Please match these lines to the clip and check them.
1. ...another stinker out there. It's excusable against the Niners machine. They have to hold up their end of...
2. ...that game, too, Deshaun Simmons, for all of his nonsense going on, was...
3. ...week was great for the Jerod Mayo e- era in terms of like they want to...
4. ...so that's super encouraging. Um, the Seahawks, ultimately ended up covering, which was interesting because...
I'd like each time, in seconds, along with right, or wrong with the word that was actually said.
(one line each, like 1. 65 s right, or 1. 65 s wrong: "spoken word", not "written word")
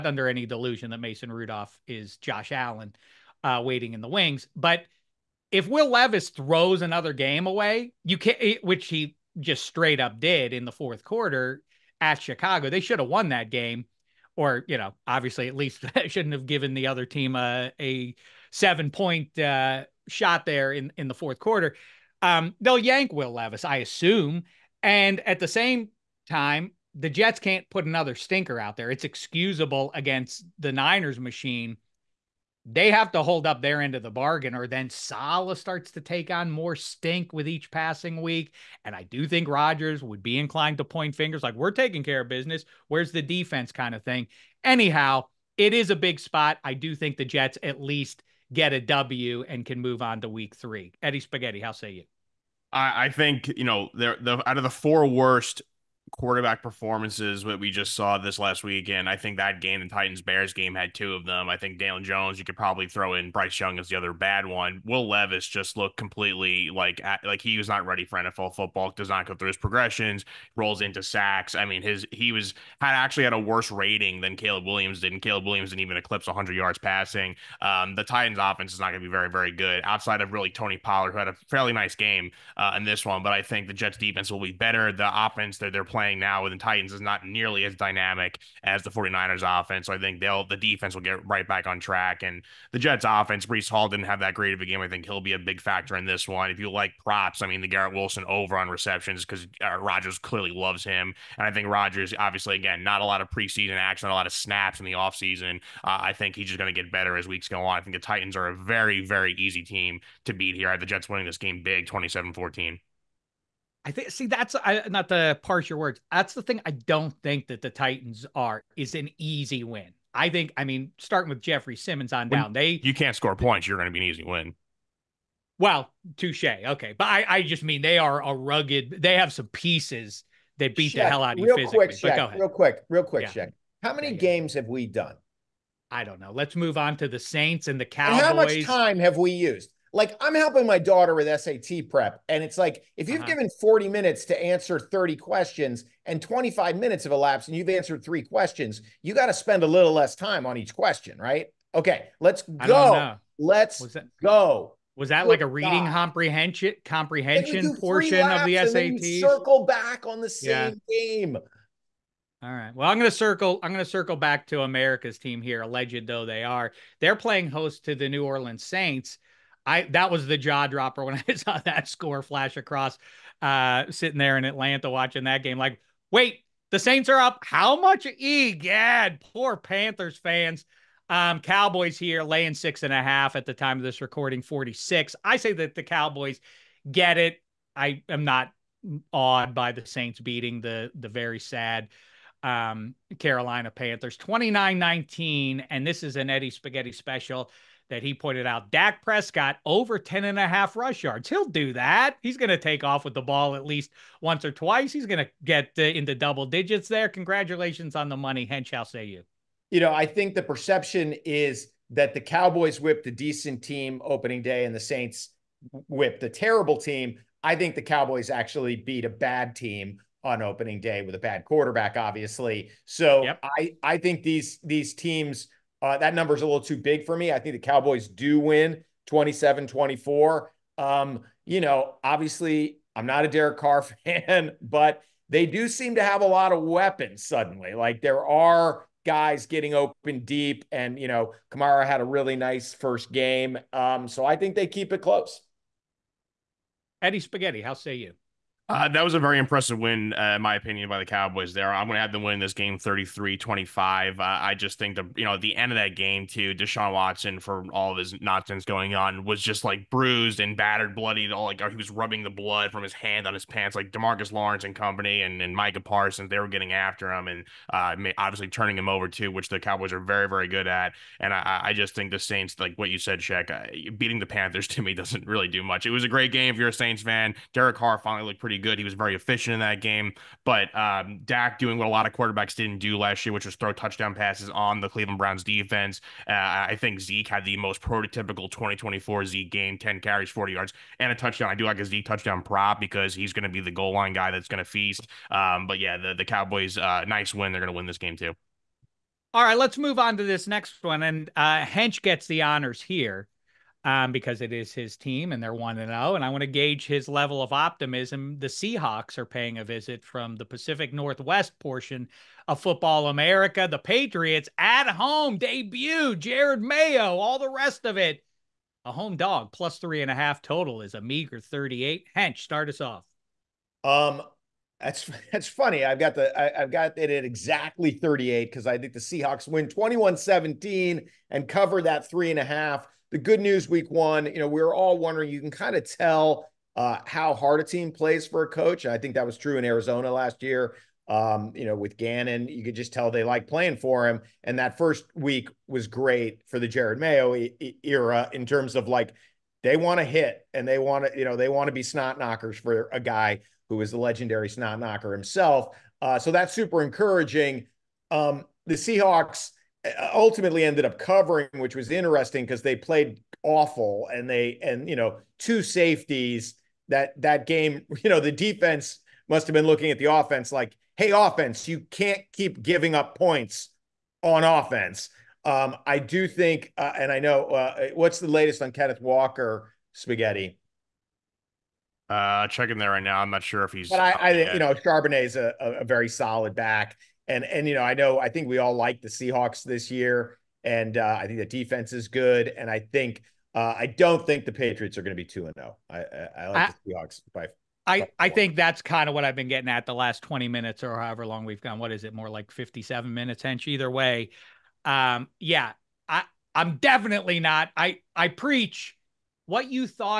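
1. 27 s right
2. 255 s wrong: "Watson", not "Simmons"
3. 345 s right
4. 356 s right.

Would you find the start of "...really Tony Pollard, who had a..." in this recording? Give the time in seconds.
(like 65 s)
80 s.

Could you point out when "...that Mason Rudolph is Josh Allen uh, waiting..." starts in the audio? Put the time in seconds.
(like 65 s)
0 s.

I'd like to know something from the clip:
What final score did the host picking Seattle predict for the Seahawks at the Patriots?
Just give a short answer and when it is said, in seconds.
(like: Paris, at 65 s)
21-17, at 329 s.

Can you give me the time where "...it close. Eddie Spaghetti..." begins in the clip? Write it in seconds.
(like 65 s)
244 s.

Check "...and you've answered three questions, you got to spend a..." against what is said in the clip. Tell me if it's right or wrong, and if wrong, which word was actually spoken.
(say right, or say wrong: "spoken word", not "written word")
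right.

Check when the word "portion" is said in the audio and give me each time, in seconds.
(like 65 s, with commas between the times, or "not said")
157 s, 311 s.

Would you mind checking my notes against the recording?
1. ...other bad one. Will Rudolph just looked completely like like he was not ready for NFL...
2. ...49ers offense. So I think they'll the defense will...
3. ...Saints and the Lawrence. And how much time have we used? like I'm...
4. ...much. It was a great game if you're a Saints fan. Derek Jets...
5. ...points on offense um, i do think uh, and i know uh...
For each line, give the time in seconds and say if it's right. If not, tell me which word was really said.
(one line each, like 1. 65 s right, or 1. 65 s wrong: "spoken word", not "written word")
1. 63 s wrong: "Levis", not "Rudolph"
2. 88 s right
3. 137 s wrong: "Cowboys", not "Lawrence"
4. 275 s wrong: "Carr", not "Jets"
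5. 373 s right.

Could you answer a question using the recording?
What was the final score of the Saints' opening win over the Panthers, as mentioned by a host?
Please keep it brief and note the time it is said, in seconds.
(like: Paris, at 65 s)
29-19, at 194 s.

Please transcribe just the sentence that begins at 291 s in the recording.
I do like a Zeke touchdown prop because he's going to be the goal line guy that's going to feast.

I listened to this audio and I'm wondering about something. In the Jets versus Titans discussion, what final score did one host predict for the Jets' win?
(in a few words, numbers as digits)
27-14.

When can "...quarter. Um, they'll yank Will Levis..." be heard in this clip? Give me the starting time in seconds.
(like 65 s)
21 s.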